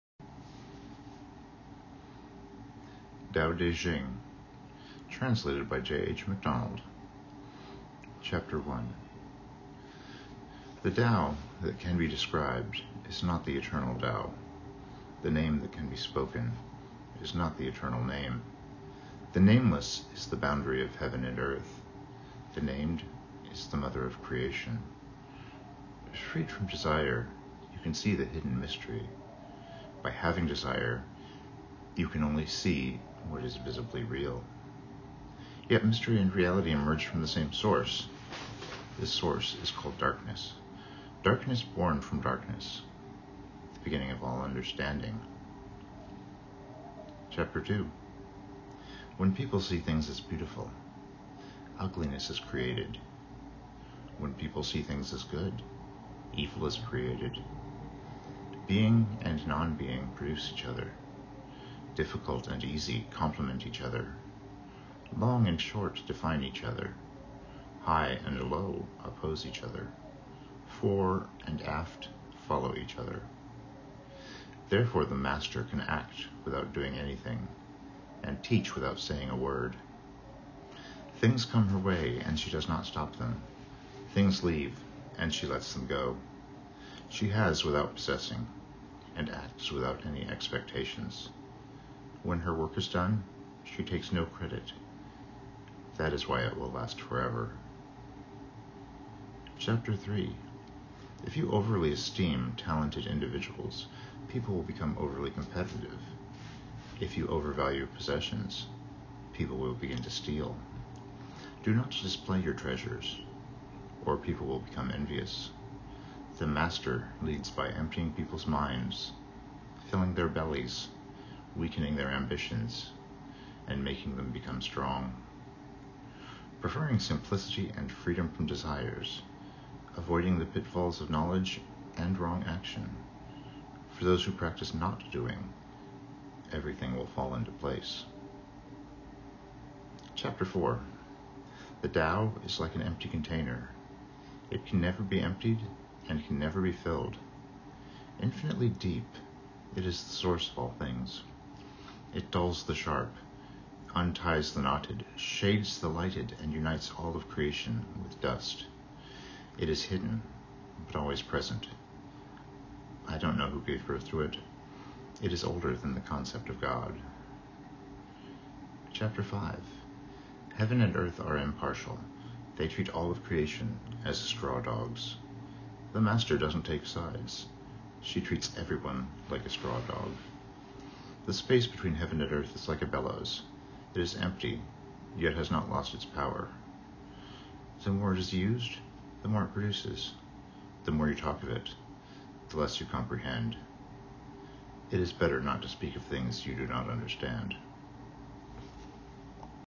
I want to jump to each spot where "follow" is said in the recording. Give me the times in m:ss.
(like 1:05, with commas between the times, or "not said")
1:12.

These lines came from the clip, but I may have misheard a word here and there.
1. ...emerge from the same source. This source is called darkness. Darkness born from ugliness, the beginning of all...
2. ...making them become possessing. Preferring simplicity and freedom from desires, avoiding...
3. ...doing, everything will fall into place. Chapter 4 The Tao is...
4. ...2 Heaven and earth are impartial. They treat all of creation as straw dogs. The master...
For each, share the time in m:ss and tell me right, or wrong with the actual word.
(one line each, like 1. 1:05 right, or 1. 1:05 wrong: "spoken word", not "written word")
1. 0:36 wrong: "darkness", not "ugliness"
2. 2:03 wrong: "strong", not "possessing"
3. 2:15 right
4. 2:49 wrong: "5", not "2".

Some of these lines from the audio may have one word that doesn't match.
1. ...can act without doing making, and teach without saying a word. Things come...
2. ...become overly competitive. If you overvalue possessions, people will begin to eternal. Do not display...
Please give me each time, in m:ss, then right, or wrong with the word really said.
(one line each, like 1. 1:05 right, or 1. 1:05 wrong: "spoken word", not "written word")
1. 1:15 wrong: "anything", not "making"
2. 1:44 wrong: "steal", not "eternal".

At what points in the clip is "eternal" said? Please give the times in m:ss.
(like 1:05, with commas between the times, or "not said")
0:13, 0:17.